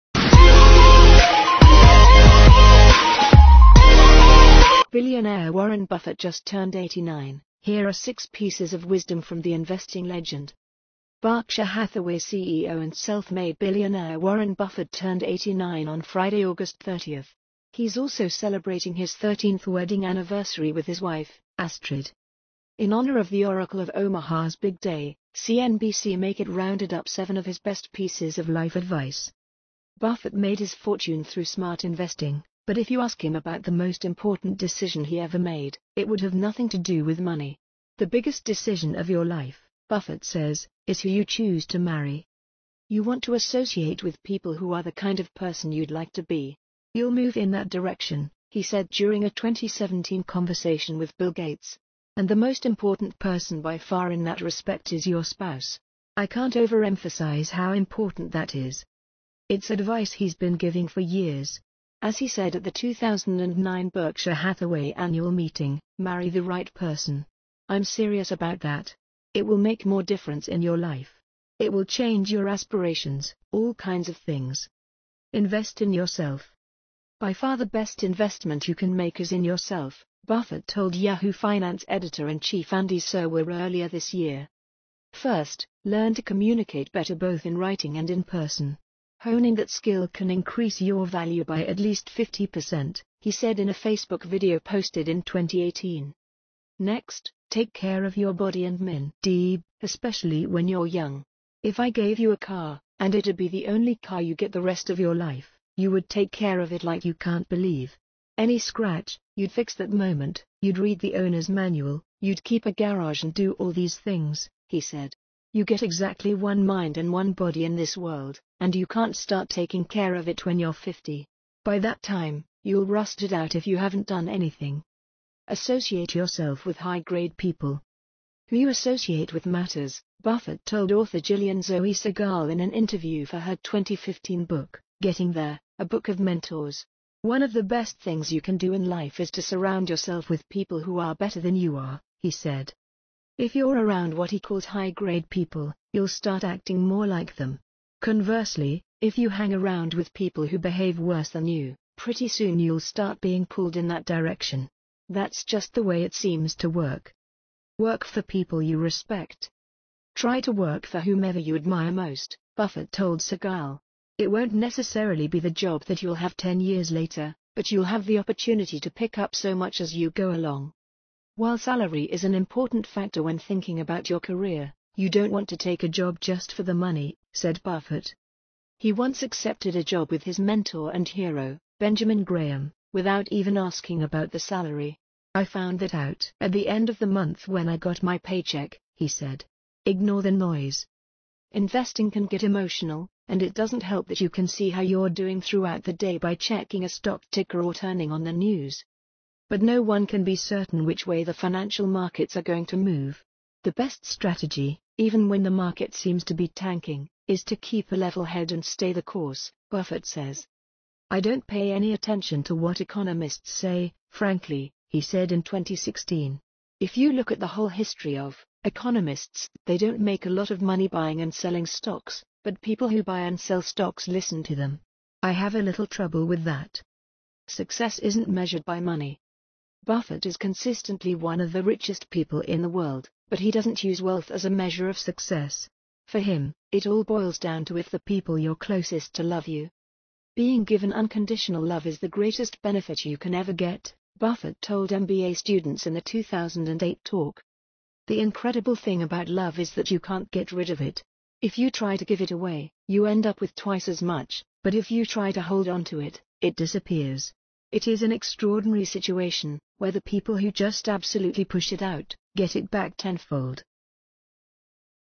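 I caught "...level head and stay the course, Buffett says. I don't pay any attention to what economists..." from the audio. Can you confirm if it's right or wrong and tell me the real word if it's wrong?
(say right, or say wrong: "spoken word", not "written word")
right.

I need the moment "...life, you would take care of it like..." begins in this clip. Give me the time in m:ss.
1:45.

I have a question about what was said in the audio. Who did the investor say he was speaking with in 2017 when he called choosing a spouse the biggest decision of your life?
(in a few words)
Bill Gates.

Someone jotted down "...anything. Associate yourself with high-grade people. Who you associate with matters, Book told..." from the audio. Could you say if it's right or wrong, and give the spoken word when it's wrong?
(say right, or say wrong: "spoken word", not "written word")
wrong: "Buffett", not "Book".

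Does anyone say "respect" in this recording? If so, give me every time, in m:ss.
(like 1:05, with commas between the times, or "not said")
0:54, 2:38.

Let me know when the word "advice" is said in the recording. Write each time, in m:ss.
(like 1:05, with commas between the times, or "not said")
0:28, 0:59.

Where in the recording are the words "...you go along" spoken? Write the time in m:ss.
2:49.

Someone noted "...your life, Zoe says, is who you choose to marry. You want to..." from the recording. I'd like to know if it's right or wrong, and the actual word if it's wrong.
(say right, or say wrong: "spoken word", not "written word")
wrong: "Buffett", not "Zoe".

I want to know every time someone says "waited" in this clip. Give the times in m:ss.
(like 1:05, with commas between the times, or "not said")
not said.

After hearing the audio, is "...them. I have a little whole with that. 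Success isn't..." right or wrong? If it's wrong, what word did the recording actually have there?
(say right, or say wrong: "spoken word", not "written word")
wrong: "trouble", not "whole".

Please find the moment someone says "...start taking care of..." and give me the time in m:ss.
1:59.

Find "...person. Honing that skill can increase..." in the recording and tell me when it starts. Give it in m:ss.
1:28.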